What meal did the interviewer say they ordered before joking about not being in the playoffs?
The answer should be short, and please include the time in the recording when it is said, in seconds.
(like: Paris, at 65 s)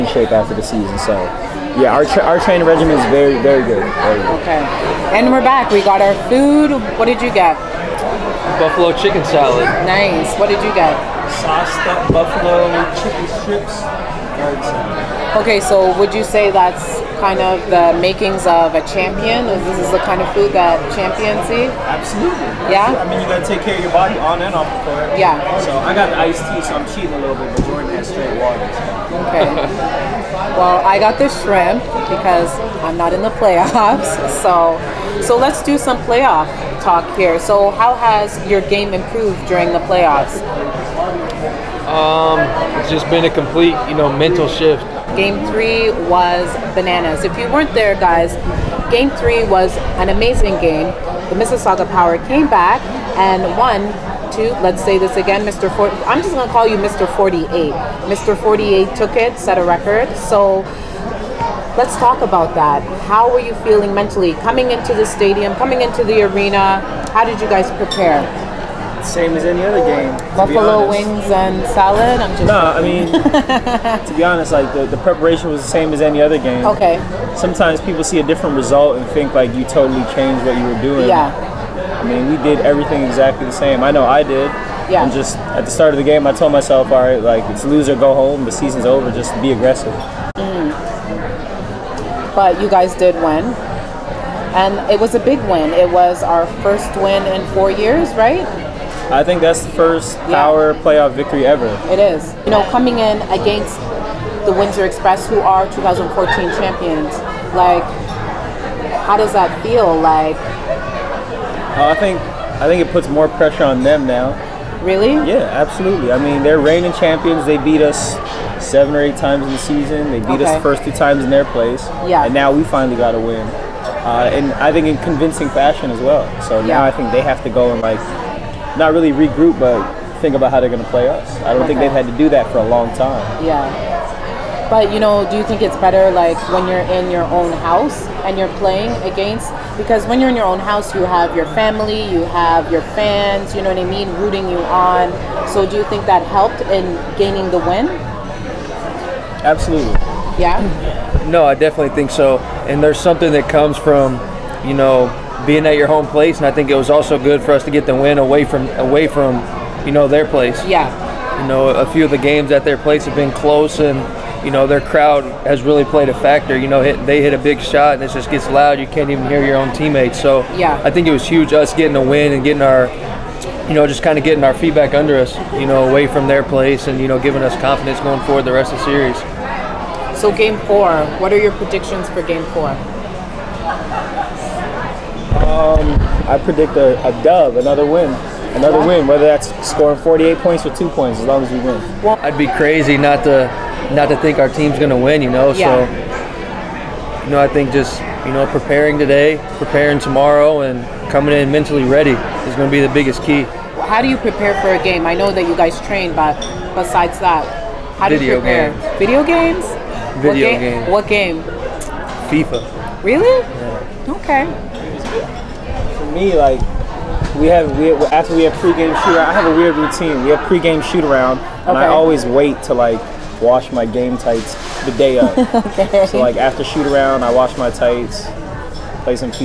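Shrimp, at 31 s.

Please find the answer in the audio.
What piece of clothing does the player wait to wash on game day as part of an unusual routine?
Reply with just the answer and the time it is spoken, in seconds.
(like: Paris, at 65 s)
Game tights, at 223 s.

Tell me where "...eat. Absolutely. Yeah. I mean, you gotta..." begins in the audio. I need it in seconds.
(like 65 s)
21 s.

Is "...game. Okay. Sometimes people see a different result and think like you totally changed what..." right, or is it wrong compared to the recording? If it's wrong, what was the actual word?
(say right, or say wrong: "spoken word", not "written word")
right.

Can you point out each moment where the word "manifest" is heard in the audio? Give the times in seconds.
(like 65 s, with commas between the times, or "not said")
not said.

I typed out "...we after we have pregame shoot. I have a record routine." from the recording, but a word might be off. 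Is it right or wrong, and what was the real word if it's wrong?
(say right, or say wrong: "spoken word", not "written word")
wrong: "weird", not "record".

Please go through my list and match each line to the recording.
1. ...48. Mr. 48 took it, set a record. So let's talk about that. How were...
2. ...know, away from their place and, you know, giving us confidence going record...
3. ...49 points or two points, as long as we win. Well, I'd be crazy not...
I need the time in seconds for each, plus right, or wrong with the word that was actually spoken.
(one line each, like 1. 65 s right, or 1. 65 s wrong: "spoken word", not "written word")
1. 57 s right
2. 175 s wrong: "forward", not "record"
3. 189 s wrong: "48", not "49".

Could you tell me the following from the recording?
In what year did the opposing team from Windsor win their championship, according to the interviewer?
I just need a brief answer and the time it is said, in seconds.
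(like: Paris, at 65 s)
2014, at 105 s.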